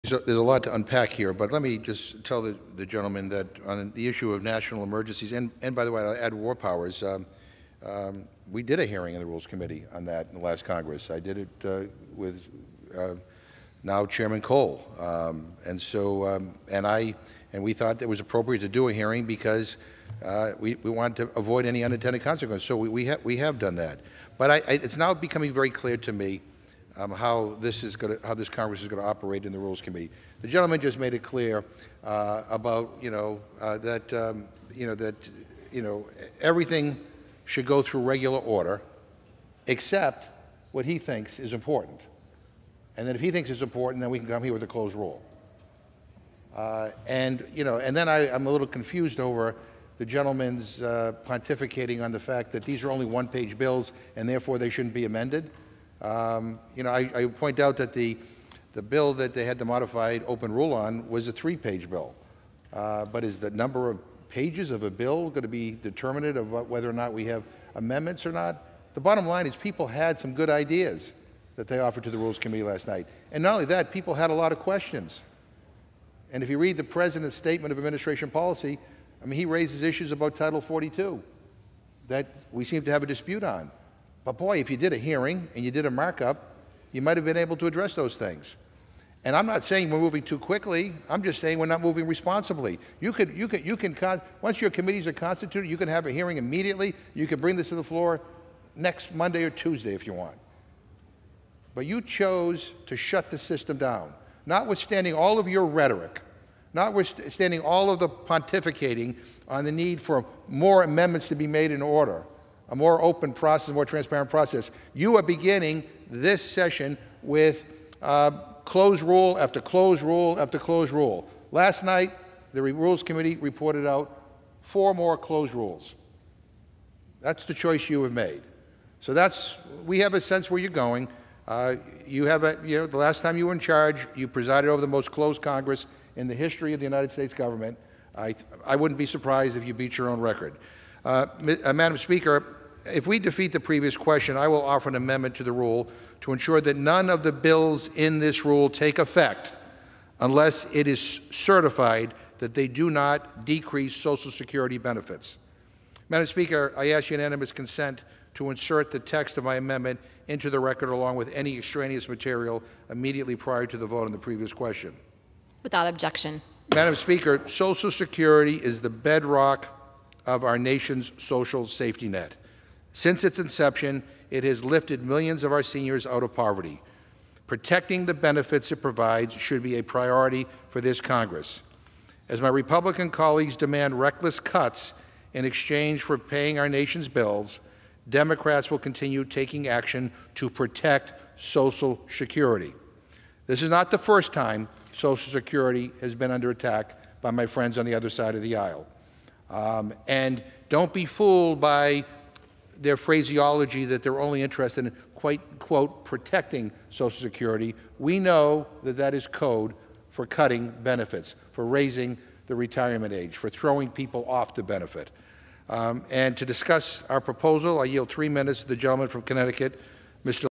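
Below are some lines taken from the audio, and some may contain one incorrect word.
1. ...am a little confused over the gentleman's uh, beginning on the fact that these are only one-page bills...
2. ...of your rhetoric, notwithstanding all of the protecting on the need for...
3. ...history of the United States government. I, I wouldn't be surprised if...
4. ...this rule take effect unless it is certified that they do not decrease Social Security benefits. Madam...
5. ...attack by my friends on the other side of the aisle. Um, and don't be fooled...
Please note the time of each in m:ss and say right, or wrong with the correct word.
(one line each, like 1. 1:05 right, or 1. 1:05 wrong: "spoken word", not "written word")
1. 0:48 wrong: "pontificating", not "beginning"
2. 1:45 wrong: "pontificating", not "protecting"
3. 2:16 right
4. 2:28 right
5. 3:16 right.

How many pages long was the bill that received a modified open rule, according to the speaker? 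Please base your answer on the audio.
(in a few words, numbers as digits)
3.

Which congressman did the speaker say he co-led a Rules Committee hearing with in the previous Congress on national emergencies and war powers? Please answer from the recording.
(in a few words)
Cole.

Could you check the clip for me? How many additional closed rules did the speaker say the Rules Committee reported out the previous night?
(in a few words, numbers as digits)
4.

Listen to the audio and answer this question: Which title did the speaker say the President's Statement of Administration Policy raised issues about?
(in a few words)
Title 42.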